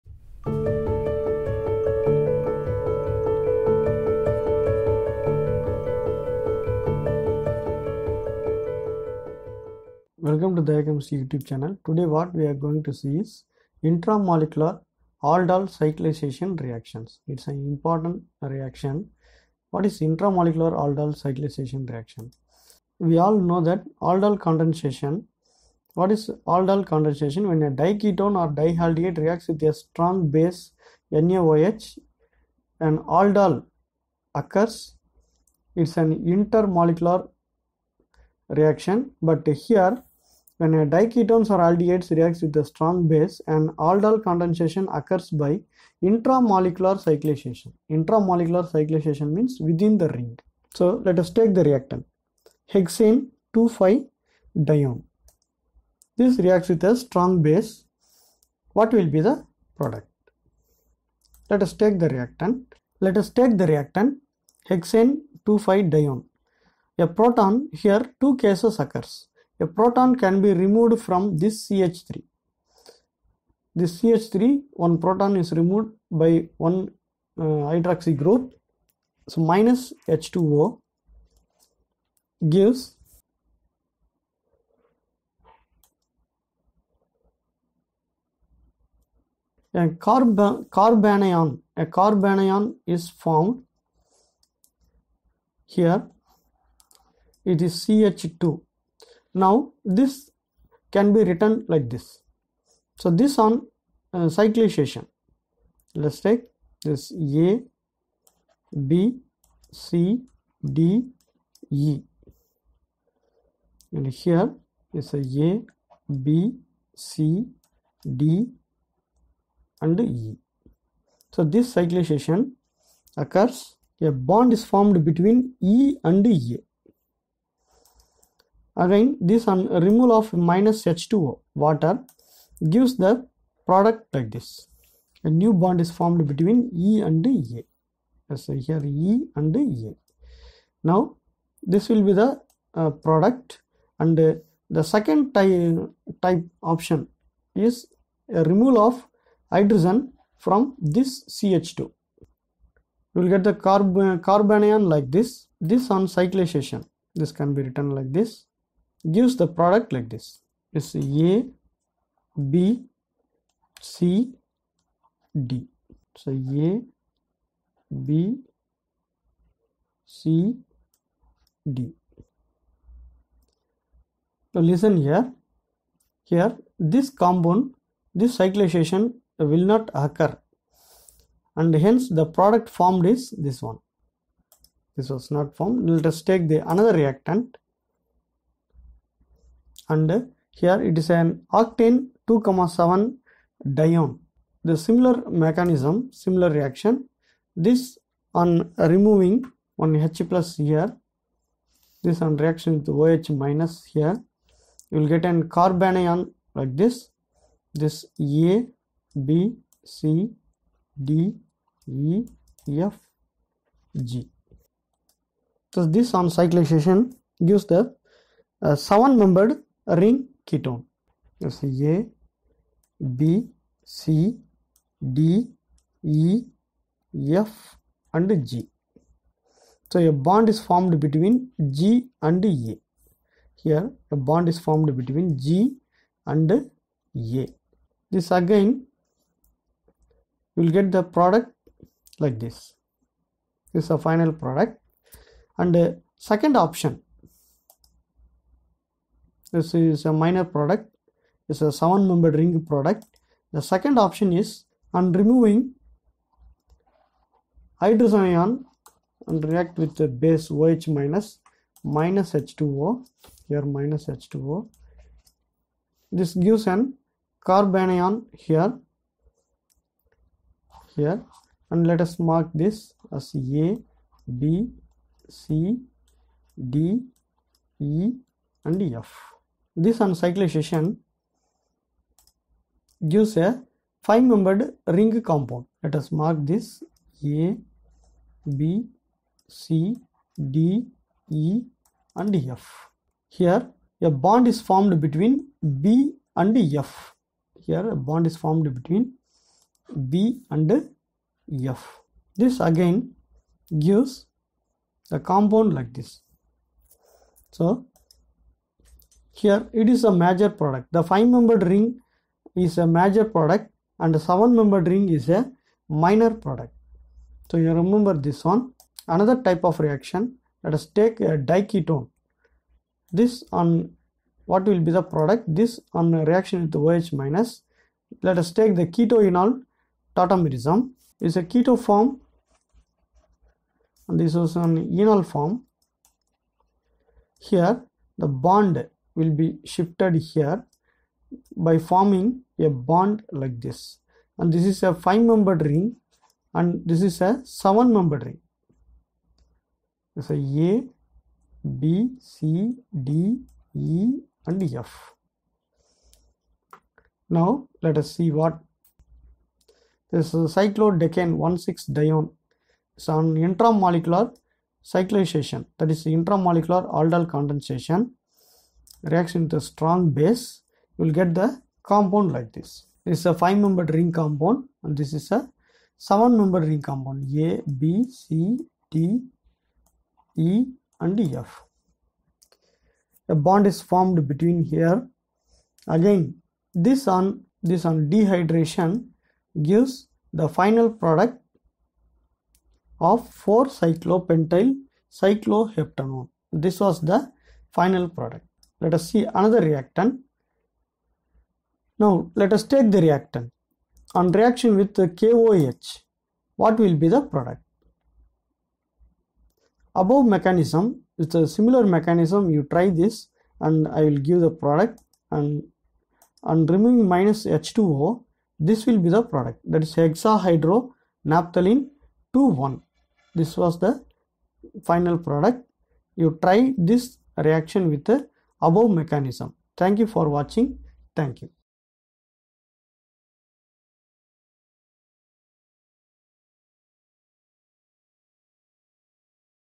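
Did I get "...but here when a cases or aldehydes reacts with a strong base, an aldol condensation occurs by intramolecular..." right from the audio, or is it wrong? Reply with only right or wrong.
wrong.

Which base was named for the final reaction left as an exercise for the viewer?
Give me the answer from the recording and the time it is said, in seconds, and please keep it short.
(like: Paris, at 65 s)
KOH, at 405 s.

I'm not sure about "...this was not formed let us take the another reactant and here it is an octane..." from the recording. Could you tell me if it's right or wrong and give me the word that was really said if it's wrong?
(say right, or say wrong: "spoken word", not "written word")
right.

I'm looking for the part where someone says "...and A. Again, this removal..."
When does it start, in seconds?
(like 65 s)
126 s.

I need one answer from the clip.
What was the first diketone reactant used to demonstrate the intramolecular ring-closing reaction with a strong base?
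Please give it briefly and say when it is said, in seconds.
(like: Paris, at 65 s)
Hexane-2,5-dione, at 52 s.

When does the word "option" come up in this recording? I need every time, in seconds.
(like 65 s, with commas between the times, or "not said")
146 s, 246 s, 253 s.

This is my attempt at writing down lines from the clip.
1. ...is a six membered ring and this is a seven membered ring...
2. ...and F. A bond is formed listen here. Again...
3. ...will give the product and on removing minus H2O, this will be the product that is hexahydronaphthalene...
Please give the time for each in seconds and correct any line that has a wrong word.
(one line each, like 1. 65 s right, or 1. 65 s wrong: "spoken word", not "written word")
1. 344 s wrong: "five", not "six"
2. 380 s wrong: "between", not "listen"
3. 414 s right.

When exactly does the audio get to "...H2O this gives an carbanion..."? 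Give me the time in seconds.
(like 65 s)
264 s.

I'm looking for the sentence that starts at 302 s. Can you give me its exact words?
This again gives the compound like this.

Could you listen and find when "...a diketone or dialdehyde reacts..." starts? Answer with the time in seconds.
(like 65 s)
27 s.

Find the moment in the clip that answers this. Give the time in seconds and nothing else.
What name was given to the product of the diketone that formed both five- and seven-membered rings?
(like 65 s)
393 s.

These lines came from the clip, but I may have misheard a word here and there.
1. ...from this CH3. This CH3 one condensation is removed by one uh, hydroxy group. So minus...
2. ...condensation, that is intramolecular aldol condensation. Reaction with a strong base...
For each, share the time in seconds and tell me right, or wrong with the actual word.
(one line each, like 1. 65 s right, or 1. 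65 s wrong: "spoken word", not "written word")
1. 71 s wrong: "proton", not "condensation"
2. 364 s wrong: "cyclization", not "condensation".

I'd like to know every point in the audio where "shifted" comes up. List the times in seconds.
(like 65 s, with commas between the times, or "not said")
339 s.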